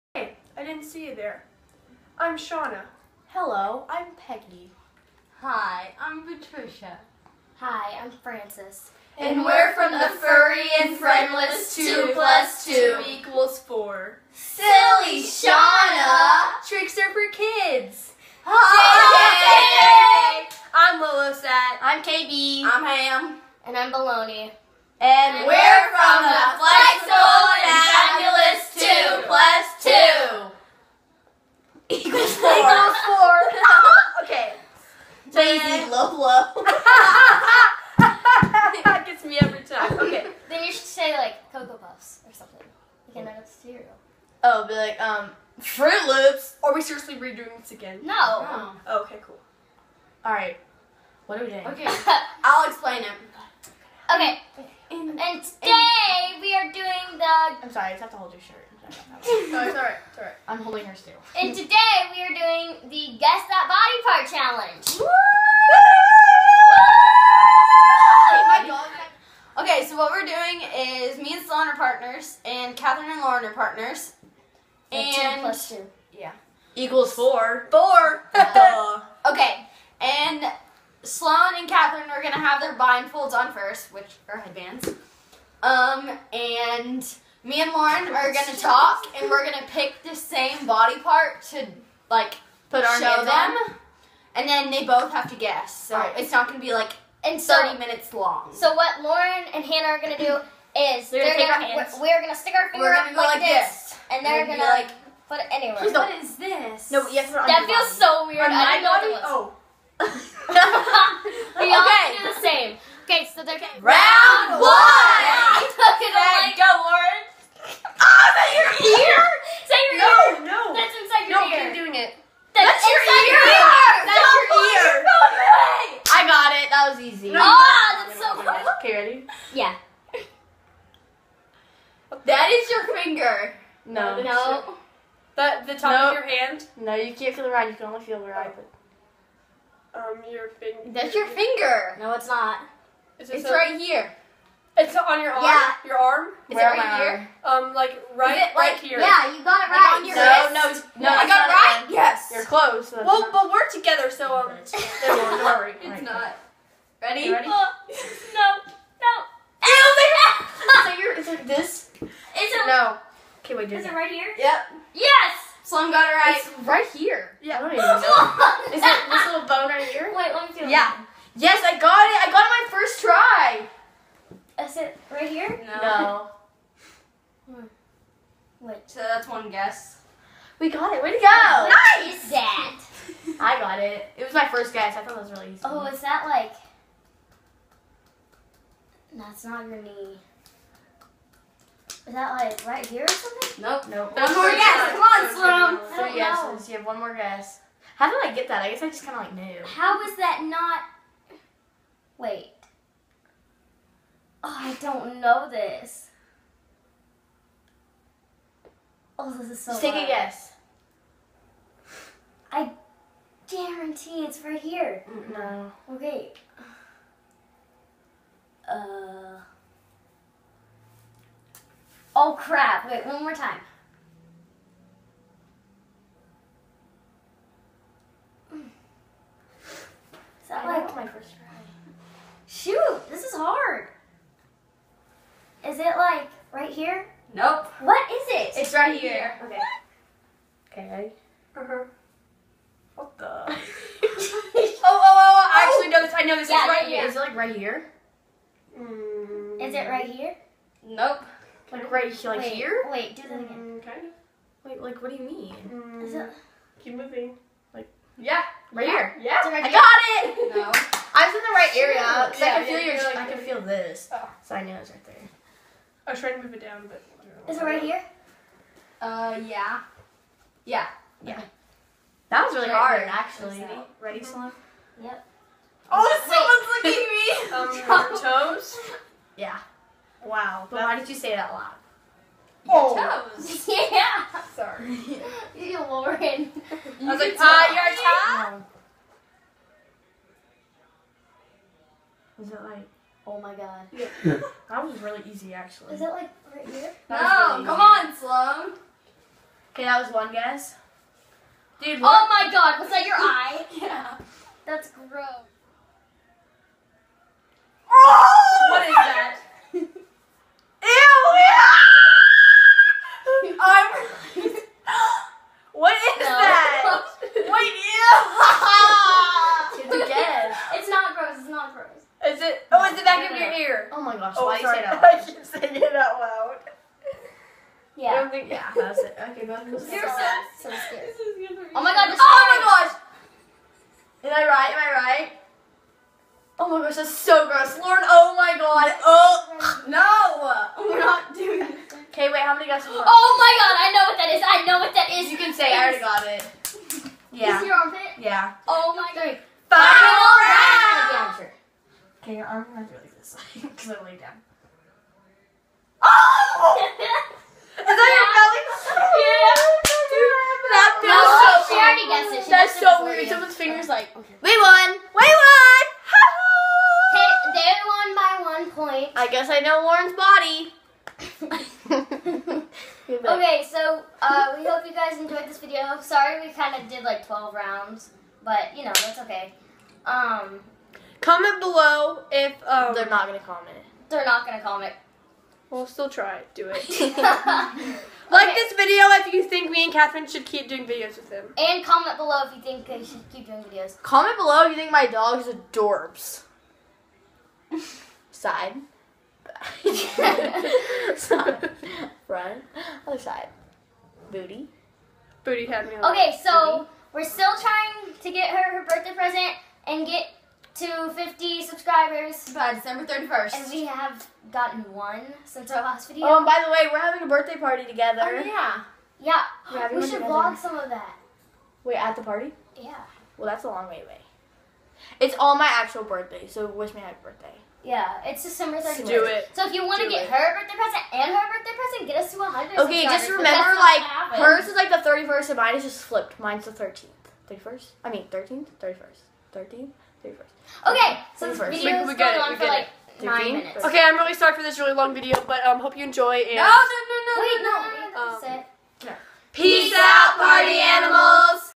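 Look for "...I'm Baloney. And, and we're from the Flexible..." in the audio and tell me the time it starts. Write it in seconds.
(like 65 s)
23 s.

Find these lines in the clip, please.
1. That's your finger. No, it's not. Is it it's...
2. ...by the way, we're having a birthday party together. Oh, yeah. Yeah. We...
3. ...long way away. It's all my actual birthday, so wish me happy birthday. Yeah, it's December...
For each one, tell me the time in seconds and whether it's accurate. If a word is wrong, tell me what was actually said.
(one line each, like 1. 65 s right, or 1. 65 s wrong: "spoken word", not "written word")
1. 140 s right
2. 416 s right
3. 423 s right.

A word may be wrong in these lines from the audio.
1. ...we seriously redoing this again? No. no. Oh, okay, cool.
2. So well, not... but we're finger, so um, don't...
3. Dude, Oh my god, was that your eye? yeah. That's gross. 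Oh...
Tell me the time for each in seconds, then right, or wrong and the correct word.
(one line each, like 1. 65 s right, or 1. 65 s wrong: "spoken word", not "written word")
1. 46 s right
2. 152 s wrong: "together", not "finger"
3. 301 s right.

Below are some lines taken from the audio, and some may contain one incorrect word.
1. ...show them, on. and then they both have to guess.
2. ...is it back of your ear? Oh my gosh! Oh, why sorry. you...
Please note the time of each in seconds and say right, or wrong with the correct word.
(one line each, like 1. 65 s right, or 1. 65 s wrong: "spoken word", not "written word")
1. 92 s right
2. 322 s right.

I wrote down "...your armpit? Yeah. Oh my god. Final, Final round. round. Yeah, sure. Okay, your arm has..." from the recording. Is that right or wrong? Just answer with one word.
right.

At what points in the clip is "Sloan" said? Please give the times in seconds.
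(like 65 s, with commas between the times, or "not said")
71 s, 81 s, 165 s, 195 s, 274 s, 298 s.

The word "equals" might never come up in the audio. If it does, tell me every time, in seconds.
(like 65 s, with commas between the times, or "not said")
13 s, 76 s.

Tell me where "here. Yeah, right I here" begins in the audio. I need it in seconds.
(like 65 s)
258 s.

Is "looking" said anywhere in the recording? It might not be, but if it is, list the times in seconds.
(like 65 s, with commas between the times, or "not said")
277 s.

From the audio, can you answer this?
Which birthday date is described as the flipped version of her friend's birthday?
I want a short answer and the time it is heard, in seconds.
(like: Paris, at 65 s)
The 13th, at 436 s.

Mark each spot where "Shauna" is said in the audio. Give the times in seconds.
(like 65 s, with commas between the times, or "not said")
2 s, 15 s.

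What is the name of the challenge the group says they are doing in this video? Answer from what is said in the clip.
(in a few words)
Guess That Body Part Challenge.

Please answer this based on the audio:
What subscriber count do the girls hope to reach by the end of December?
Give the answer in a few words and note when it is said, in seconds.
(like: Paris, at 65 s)
50, at 411 s.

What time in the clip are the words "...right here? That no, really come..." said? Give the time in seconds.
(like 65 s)
296 s.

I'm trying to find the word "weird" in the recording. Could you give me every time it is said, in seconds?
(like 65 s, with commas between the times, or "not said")
108 s, 363 s.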